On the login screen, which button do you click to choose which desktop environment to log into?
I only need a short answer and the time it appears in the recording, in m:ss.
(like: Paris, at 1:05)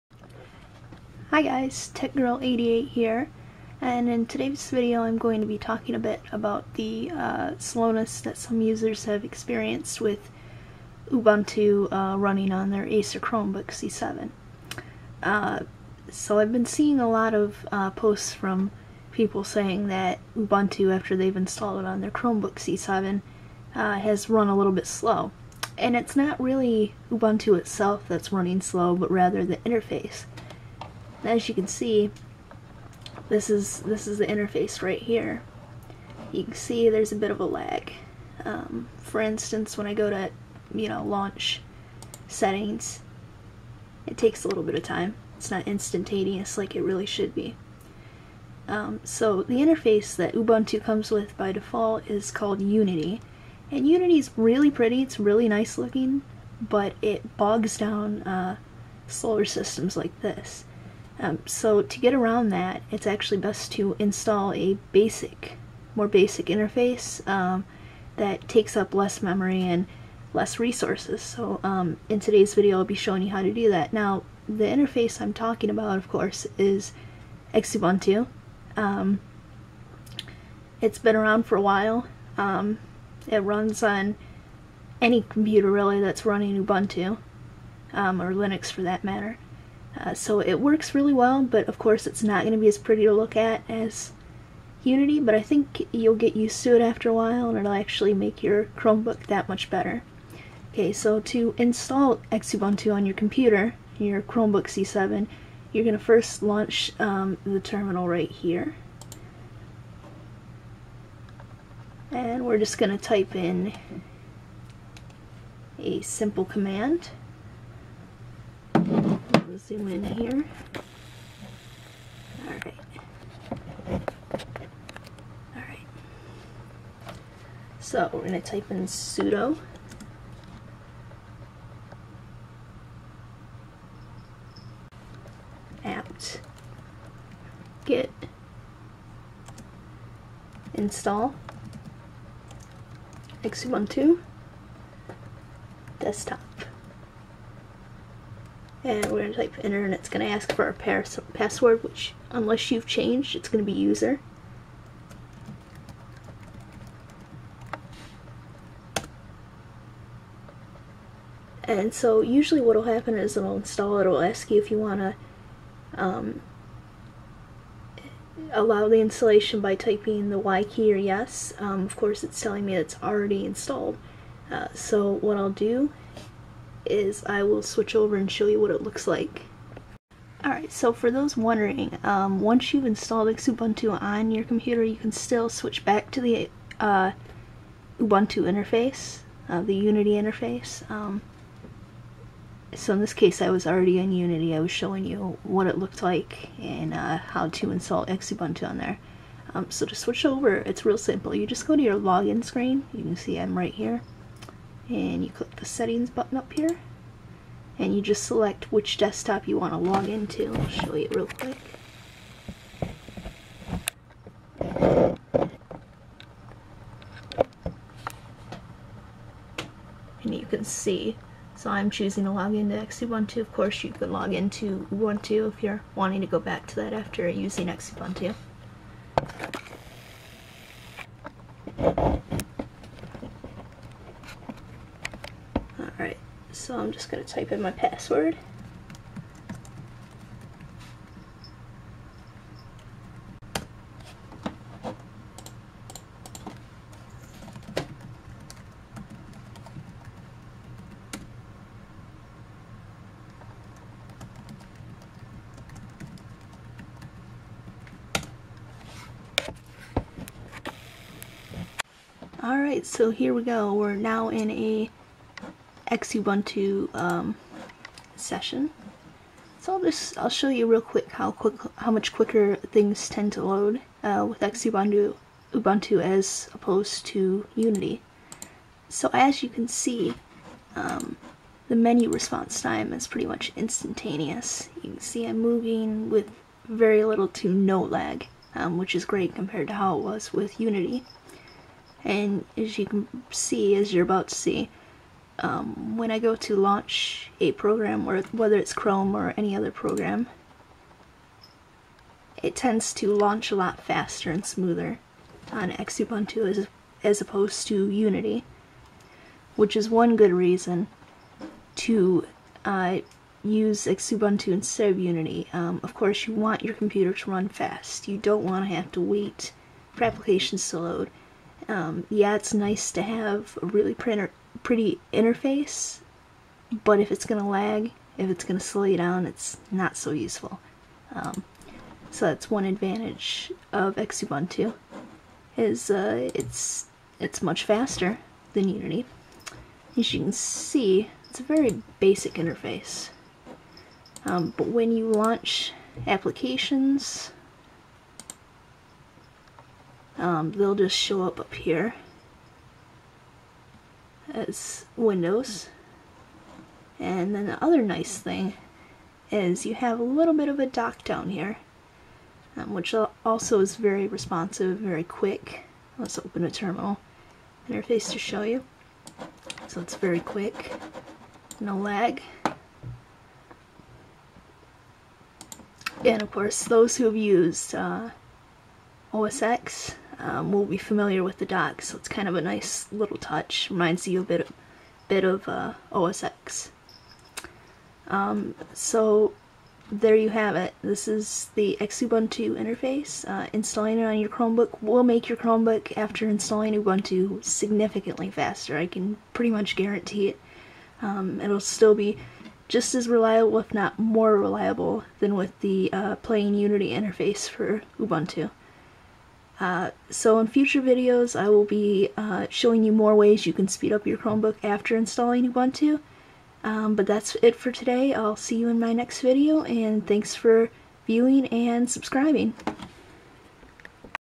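settings button, at 3:25.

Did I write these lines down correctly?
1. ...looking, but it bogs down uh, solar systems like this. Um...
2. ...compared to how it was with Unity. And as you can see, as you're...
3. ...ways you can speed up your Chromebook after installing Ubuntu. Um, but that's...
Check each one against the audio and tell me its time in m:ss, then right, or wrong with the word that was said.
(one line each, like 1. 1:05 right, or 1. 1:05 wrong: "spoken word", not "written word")
1. 0:55 right
2. 4:49 right
3. 6:53 right.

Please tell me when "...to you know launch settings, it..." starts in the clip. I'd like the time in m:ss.
0:40.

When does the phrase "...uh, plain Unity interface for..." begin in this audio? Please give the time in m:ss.
6:45.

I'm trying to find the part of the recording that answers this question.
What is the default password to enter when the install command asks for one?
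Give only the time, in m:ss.
2:33.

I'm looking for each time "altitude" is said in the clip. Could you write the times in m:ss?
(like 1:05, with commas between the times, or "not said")
not said.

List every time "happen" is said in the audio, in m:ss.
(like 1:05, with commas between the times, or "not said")
2:42.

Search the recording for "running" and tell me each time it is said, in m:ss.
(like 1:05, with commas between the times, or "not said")
0:12, 0:28, 1:26.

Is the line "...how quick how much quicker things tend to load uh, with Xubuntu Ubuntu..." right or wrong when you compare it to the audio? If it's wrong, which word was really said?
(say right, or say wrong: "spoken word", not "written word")
right.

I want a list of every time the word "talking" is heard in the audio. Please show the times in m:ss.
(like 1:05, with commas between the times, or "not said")
0:05, 1:15.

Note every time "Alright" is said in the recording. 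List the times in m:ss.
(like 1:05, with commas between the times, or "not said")
3:00, 4:22.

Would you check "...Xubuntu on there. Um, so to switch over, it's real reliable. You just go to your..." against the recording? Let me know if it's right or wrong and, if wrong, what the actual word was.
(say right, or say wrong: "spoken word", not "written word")
wrong: "simple", not "reliable".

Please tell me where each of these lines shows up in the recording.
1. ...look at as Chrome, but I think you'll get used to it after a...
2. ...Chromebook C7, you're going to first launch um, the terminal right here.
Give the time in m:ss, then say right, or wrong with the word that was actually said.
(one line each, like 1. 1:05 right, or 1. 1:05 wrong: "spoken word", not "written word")
1. 1:33 wrong: "Unity", not "Chrome"
2. 1:44 right.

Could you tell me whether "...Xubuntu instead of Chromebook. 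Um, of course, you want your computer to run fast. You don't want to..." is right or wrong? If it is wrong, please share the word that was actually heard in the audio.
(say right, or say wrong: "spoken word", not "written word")
wrong: "Unity", not "Chromebook".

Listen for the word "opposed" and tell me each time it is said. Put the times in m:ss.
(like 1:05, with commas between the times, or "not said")
4:36, 5:07.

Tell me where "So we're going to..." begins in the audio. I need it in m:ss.
2:07.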